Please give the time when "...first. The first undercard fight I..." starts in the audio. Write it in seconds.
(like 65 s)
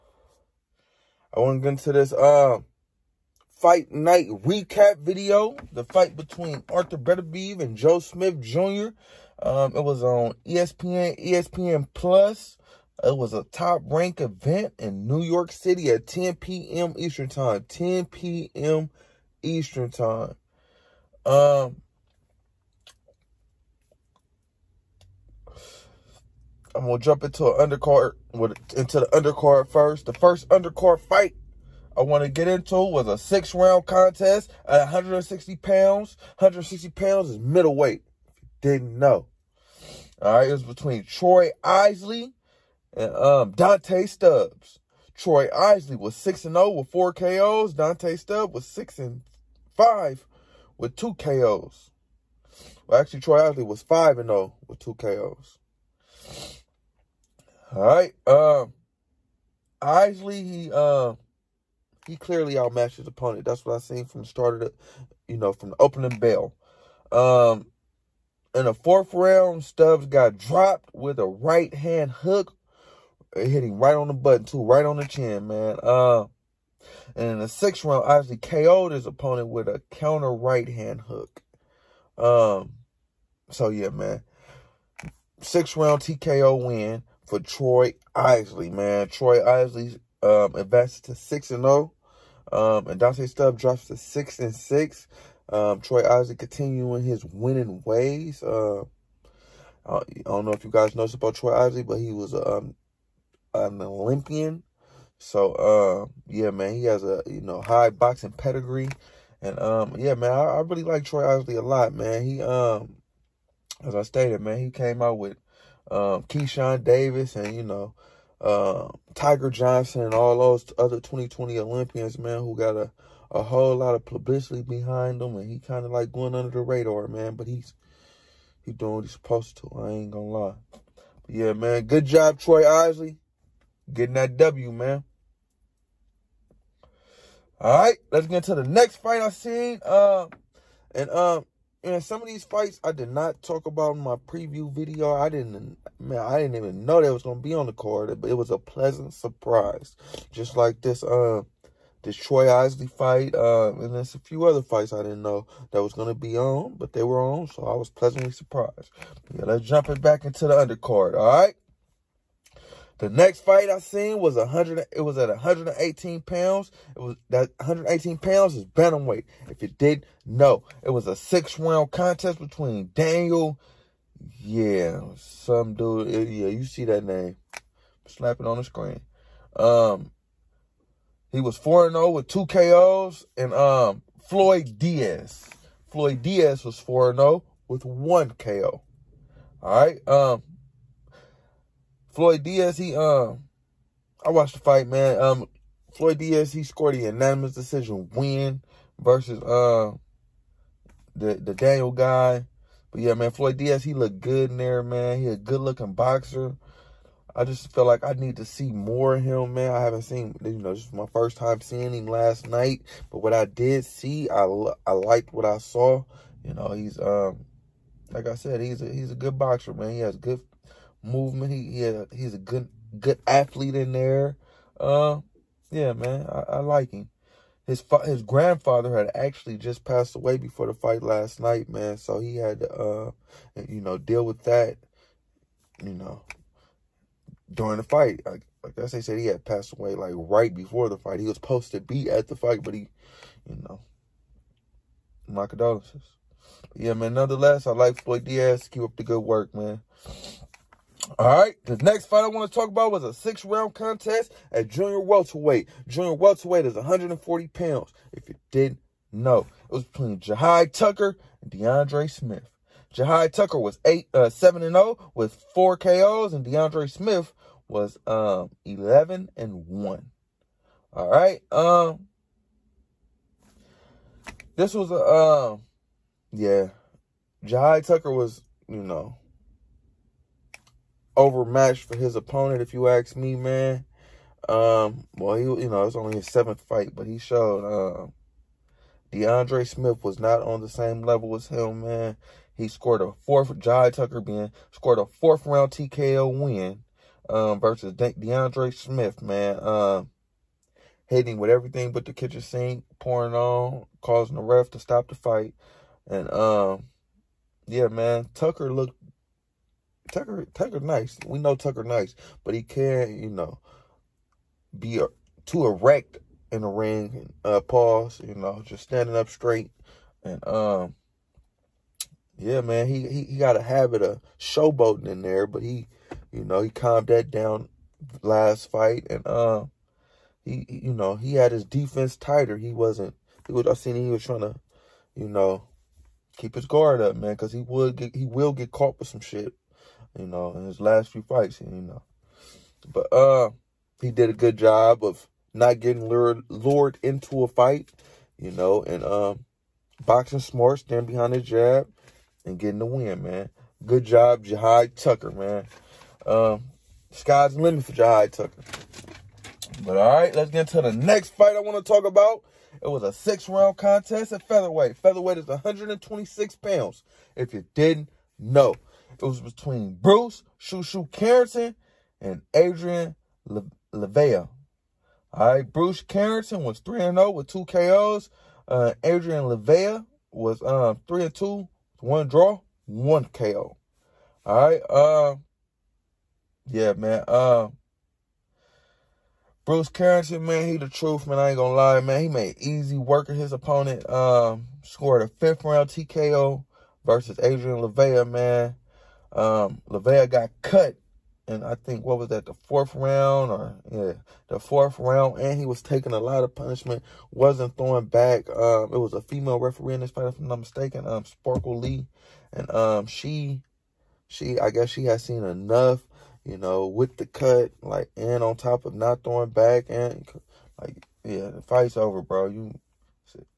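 29 s.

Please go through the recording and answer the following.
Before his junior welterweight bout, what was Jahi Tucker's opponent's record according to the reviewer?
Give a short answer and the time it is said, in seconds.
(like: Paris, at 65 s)
11-1, at 268 s.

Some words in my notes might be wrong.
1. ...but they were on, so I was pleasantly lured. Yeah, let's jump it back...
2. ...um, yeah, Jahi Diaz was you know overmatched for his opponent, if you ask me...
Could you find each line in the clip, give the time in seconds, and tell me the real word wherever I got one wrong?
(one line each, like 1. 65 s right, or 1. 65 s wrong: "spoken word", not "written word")
1. 156 s wrong: "surprised", not "lured"
2. 274 s wrong: "Tucker", not "Diaz".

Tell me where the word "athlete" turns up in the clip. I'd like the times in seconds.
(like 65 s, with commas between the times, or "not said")
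223 s.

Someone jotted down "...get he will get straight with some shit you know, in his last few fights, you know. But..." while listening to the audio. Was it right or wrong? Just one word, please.
wrong.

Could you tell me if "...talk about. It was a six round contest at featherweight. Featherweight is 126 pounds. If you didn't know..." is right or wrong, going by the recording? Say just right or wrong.
right.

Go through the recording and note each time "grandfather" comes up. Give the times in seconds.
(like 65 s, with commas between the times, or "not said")
228 s.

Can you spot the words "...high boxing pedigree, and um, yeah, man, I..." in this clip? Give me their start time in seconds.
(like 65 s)
107 s.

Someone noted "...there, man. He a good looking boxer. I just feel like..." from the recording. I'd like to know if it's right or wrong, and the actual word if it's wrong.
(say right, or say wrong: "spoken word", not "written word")
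right.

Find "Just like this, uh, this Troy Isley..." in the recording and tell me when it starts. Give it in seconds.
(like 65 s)
150 s.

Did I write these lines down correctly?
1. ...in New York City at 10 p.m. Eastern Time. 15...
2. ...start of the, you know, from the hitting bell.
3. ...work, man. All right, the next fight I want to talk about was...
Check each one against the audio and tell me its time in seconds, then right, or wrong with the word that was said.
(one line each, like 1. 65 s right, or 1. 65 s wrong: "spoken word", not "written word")
1. 14 s wrong: "10", not "15"
2. 64 s wrong: "opening", not "hitting"
3. 249 s right.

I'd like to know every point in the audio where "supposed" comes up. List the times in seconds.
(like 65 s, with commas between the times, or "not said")
129 s, 241 s.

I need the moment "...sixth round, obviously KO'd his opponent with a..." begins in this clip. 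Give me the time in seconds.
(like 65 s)
77 s.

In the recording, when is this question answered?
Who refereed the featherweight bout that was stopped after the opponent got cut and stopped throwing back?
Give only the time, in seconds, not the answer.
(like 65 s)
411 s.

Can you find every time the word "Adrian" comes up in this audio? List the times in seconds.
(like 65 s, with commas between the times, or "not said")
372 s, 379 s, 397 s.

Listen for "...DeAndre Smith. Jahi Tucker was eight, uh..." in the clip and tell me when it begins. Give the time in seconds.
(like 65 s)
261 s.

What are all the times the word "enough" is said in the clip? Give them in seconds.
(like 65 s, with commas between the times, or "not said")
415 s.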